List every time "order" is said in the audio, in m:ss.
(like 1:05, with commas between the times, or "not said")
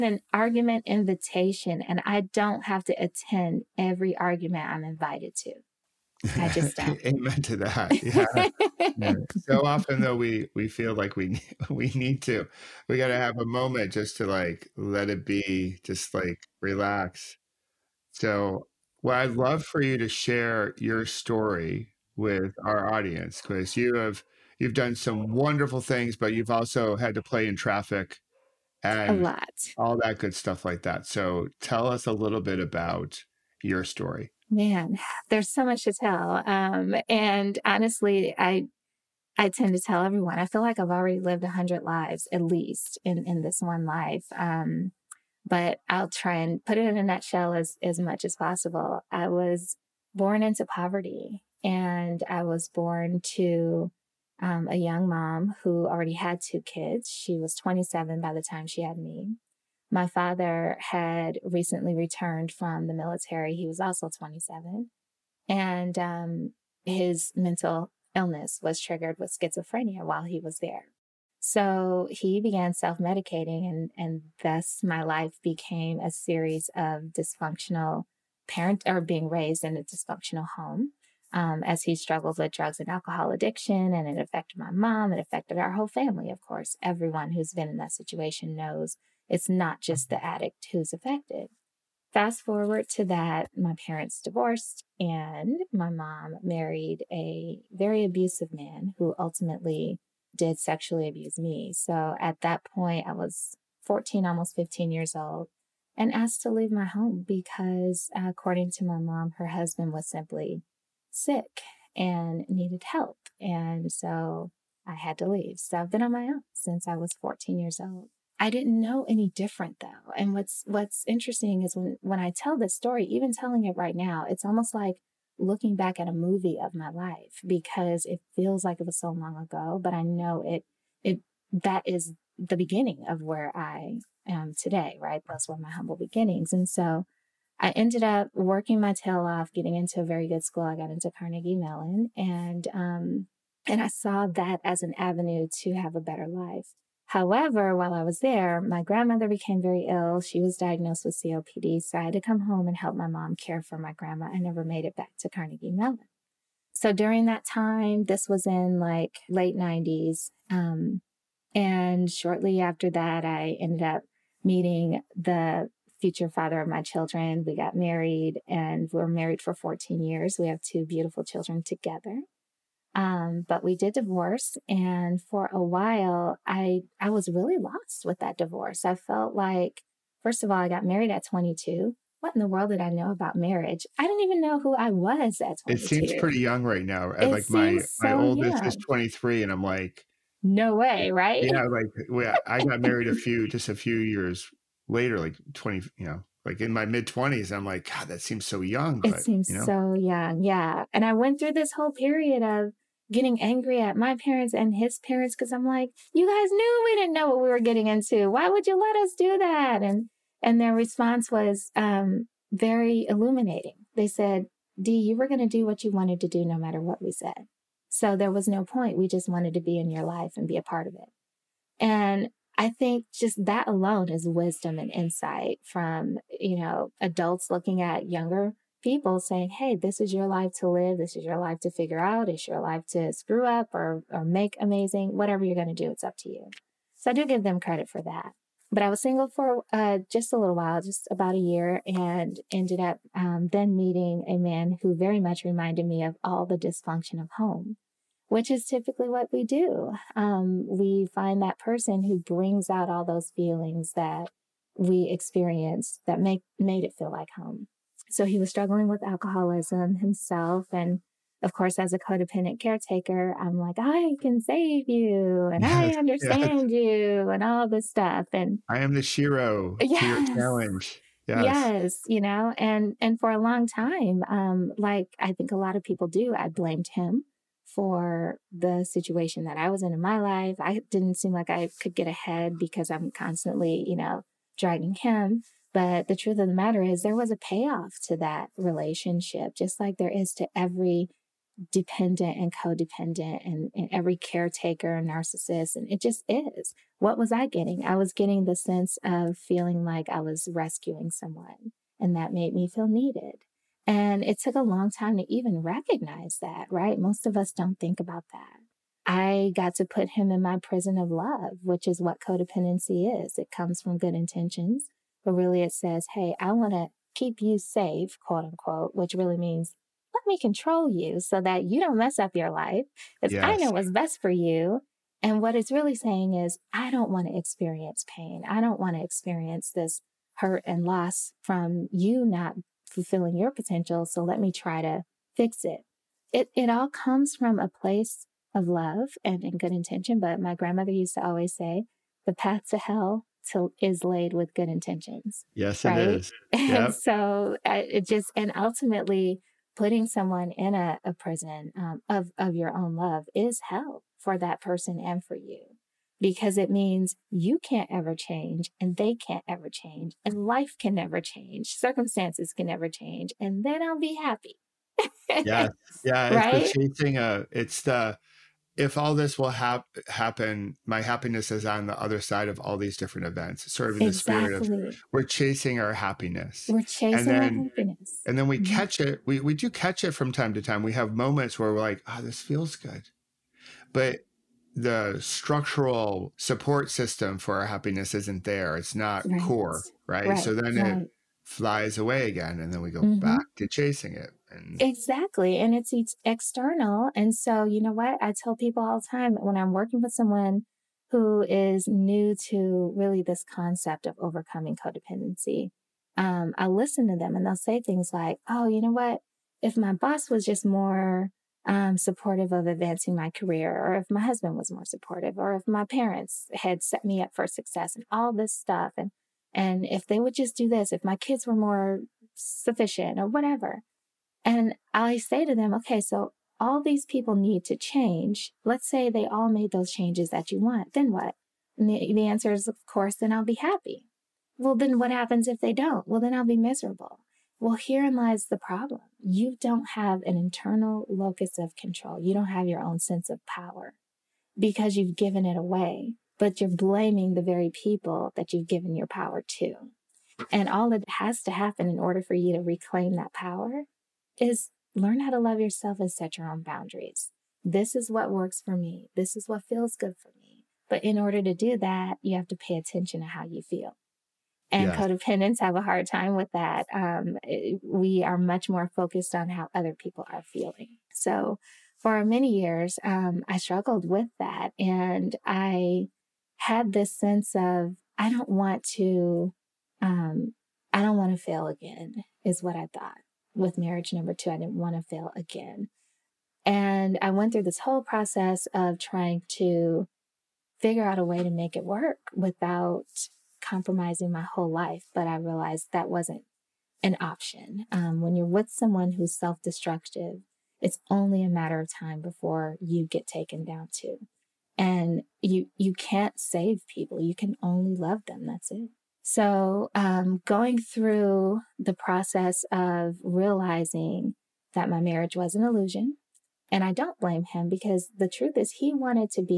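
7:31, 7:41.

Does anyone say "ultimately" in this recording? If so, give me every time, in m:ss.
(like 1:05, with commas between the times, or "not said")
1:39, 5:48.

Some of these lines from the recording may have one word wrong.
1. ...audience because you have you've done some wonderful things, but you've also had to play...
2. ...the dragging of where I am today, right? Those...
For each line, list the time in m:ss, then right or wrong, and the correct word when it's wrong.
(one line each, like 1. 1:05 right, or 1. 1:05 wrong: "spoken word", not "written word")
1. 0:22 right
2. 2:12 wrong: "beginning", not "dragging".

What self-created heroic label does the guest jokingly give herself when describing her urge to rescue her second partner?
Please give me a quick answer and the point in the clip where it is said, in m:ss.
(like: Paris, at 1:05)
the shero, at 4:28.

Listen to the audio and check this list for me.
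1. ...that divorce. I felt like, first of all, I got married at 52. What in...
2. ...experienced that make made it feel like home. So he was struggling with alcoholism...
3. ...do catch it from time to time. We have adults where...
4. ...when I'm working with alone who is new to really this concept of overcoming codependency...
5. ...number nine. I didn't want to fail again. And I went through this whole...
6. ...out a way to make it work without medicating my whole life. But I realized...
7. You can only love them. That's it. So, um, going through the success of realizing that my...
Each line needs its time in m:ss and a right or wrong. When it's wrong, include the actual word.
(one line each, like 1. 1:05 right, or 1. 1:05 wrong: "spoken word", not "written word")
1. 2:58 wrong: "22", not "52"
2. 4:15 right
3. 6:19 wrong: "moments", not "adults"
4. 6:39 wrong: "someone", not "alone"
5. 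8:04 wrong: "two", not "nine"
6. 8:11 wrong: "compromising", not "medicating"
7. 8:27 wrong: "process", not "success".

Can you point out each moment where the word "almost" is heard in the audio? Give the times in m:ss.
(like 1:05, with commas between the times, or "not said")
1:44, 2:04.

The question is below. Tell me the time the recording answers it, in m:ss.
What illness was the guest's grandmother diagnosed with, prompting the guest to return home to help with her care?
2:31.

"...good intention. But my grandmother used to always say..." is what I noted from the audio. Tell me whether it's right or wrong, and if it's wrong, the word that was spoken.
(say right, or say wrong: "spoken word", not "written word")
right.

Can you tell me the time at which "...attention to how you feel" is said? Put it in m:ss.
7:42.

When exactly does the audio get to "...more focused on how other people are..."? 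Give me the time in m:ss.
7:48.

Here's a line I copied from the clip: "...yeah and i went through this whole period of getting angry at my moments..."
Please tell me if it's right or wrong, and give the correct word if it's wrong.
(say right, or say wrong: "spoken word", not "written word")
wrong: "parents", not "moments".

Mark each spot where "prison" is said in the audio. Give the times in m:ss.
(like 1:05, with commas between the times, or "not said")
5:10, 5:51.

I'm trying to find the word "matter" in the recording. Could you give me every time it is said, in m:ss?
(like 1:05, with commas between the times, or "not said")
3:36, 4:46, 8:21.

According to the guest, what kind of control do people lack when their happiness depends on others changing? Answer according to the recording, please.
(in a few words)
internal locus of control.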